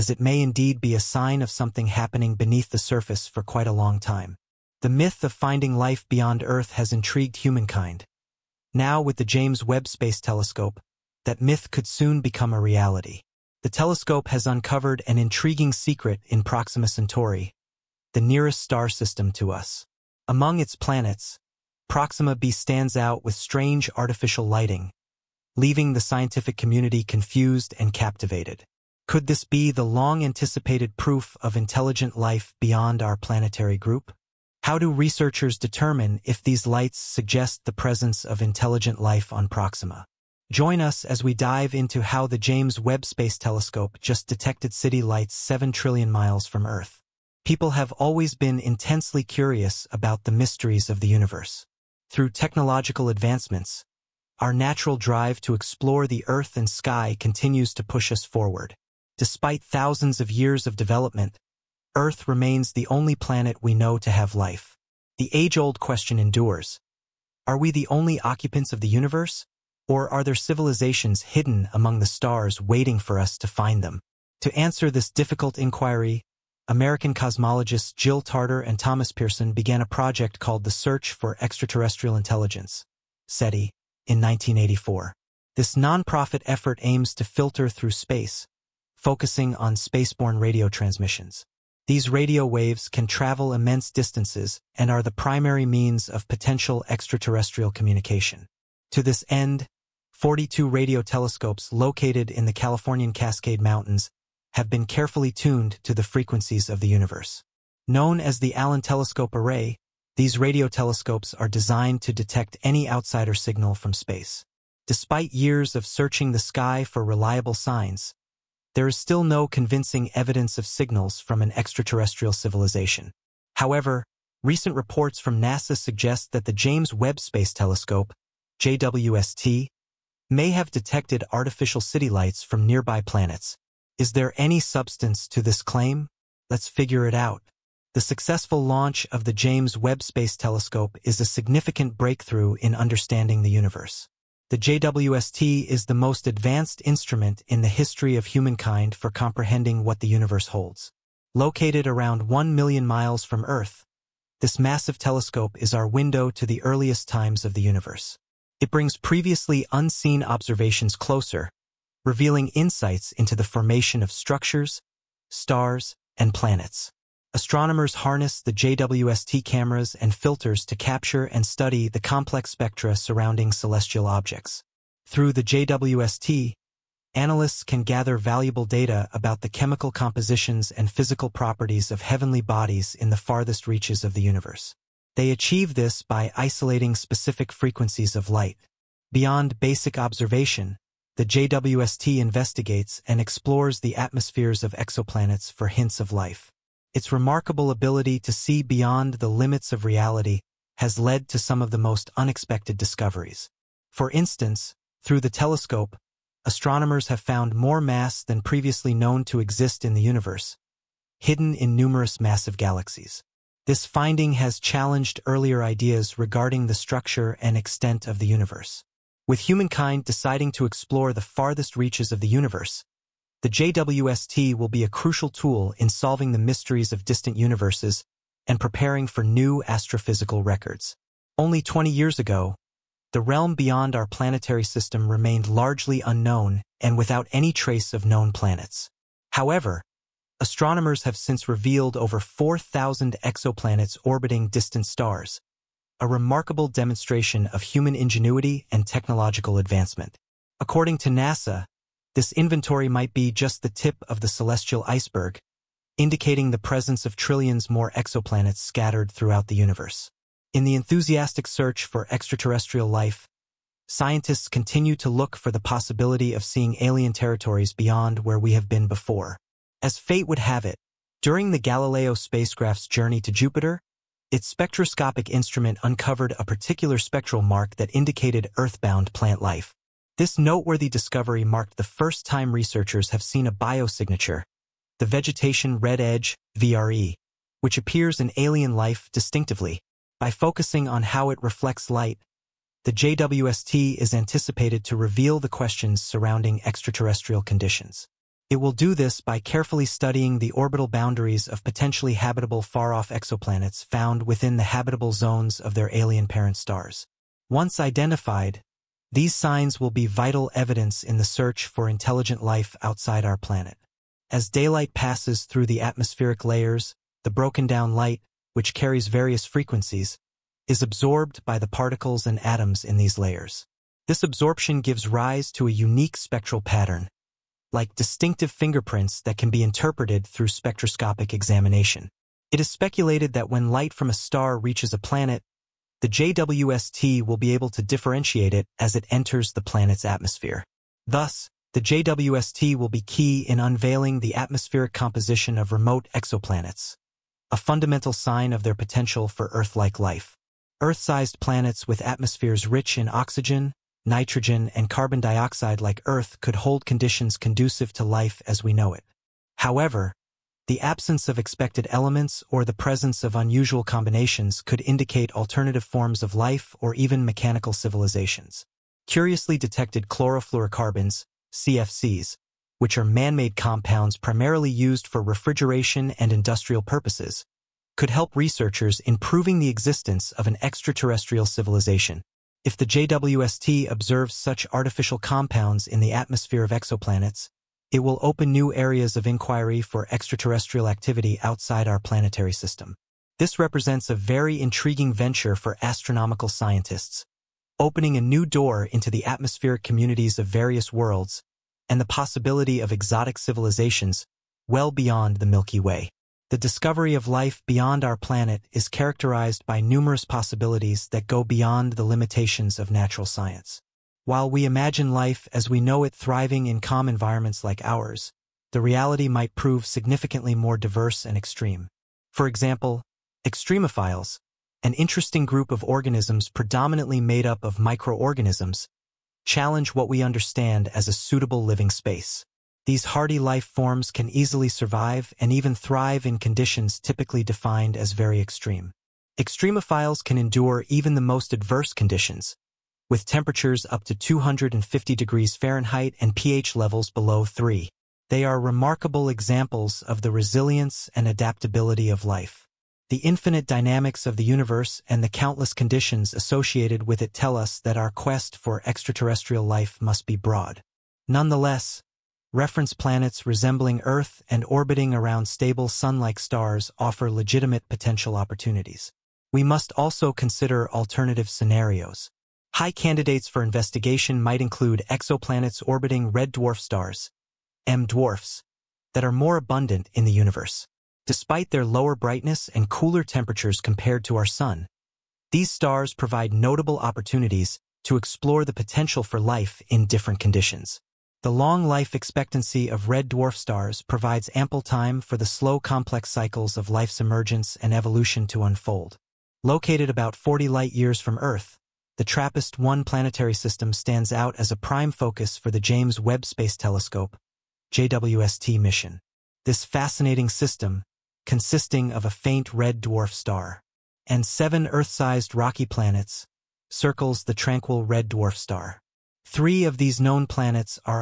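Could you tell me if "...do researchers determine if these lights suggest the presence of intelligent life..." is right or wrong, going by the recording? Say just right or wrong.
right.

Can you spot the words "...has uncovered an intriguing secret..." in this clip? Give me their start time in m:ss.
0:14.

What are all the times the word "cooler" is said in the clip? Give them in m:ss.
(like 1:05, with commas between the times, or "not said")
8:02.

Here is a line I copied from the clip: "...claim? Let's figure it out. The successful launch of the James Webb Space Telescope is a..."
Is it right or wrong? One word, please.
right.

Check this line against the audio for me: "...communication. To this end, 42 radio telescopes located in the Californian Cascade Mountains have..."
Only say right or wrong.
right.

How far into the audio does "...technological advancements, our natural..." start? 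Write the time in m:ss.
0:52.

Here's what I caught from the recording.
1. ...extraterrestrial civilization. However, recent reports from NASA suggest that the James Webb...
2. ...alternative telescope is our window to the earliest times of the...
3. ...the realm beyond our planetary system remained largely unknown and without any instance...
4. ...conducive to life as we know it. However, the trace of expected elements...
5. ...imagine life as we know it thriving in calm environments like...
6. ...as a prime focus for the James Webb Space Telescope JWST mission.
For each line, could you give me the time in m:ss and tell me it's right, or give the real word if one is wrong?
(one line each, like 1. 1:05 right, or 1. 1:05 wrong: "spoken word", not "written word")
1. 2:01 right
2. 2:34 wrong: "massive", not "alternative"
3. 3:53 wrong: "trace", not "instance"
4. 5:57 wrong: "absence", not "trace"
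5. 6:54 right
6. 8:24 right.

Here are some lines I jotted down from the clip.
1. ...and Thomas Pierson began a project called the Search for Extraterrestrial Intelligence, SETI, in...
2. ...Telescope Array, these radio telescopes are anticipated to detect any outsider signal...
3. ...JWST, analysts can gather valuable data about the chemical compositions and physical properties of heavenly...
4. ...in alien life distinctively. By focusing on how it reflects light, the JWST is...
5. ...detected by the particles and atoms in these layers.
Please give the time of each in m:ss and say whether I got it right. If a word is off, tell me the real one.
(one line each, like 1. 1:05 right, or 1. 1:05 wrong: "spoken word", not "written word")
1. 1:18 right
2. 1:48 wrong: "designed", not "anticipated"
3. 2:55 right
4. 4:48 right
5. 5:20 wrong: "absorbed", not "detected".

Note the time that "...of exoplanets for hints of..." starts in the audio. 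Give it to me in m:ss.
3:14.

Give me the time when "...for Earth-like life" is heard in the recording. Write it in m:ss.
5:49.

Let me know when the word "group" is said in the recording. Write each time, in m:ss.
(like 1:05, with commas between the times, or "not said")
0:33, 7:05.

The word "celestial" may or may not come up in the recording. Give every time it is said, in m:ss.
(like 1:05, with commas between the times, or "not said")
2:53, 4:14.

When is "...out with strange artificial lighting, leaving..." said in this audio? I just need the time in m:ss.
0:22.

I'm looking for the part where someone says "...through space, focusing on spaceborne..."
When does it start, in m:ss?
1:27.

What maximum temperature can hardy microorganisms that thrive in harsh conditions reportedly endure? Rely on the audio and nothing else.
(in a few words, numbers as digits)
250 degrees Fahrenheit.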